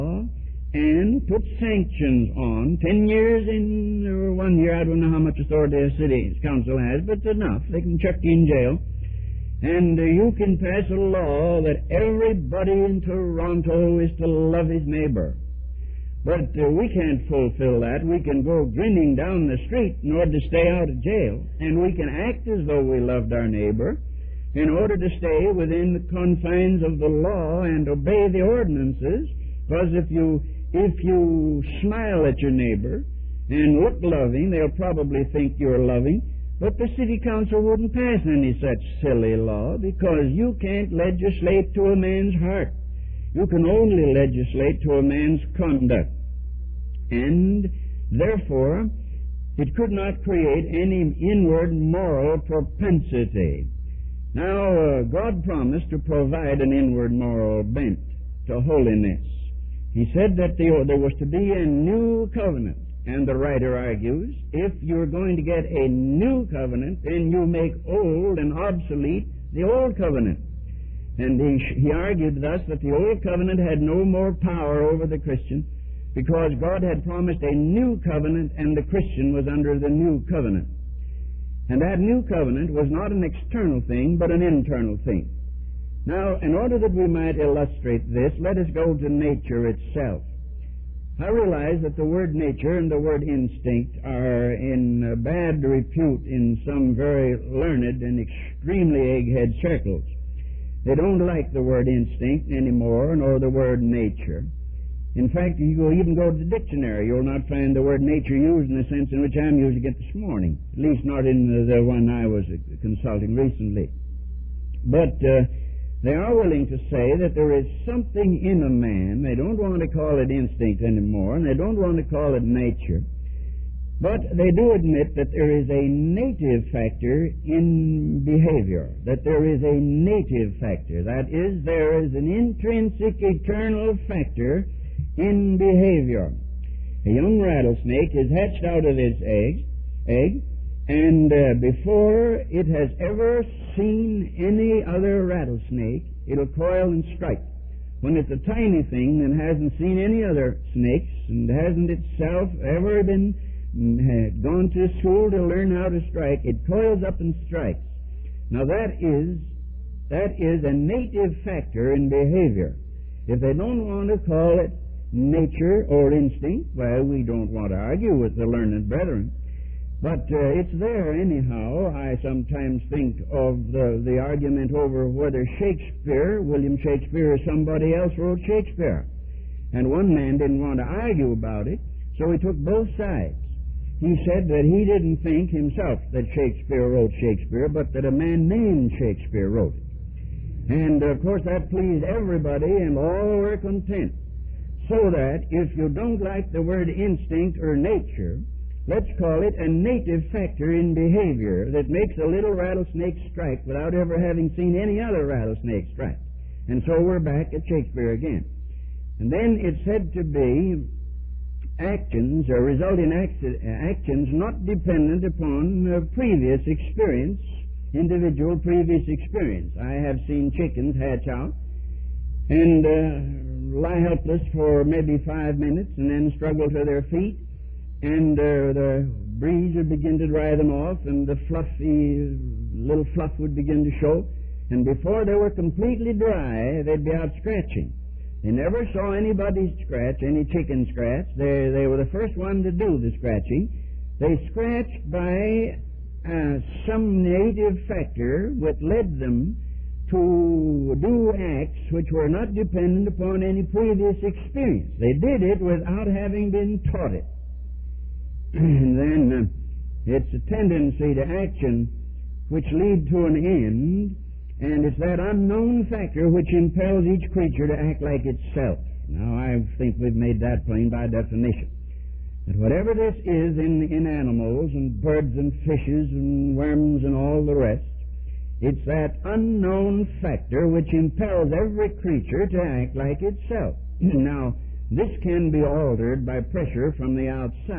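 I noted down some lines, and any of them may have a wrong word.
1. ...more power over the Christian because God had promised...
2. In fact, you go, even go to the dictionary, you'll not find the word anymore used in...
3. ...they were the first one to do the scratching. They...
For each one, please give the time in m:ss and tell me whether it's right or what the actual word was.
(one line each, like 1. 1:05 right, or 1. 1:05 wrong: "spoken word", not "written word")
1. 1:14 right
2. 1:45 wrong: "nature", not "anymore"
3. 4:01 right.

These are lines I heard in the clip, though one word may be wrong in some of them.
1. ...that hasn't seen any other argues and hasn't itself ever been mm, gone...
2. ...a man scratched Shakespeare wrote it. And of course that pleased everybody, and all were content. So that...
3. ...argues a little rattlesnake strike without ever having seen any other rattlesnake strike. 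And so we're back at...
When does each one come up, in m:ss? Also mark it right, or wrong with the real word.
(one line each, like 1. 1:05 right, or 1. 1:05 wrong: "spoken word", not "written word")
1. 2:29 wrong: "snakes", not "argues"
2. 3:08 wrong: "named", not "scratched"
3. 3:21 wrong: "makes", not "argues".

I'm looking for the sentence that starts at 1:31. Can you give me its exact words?
I realize that the word nature and the word instinct are in bad repute in some very learned and extremely egghead circles.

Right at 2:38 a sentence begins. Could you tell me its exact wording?
Now that is that is a native factor in behavior.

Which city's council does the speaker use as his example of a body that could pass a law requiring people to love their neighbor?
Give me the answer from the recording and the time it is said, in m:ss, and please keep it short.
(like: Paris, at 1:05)
Toronto, at 0:12.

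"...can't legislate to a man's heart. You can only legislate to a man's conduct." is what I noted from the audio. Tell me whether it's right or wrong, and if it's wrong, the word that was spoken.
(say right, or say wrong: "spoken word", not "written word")
right.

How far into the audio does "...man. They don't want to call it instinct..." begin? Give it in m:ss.
1:58.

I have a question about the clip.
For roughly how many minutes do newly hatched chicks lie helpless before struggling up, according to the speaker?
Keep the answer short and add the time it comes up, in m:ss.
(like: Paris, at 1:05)
5, at 3:45.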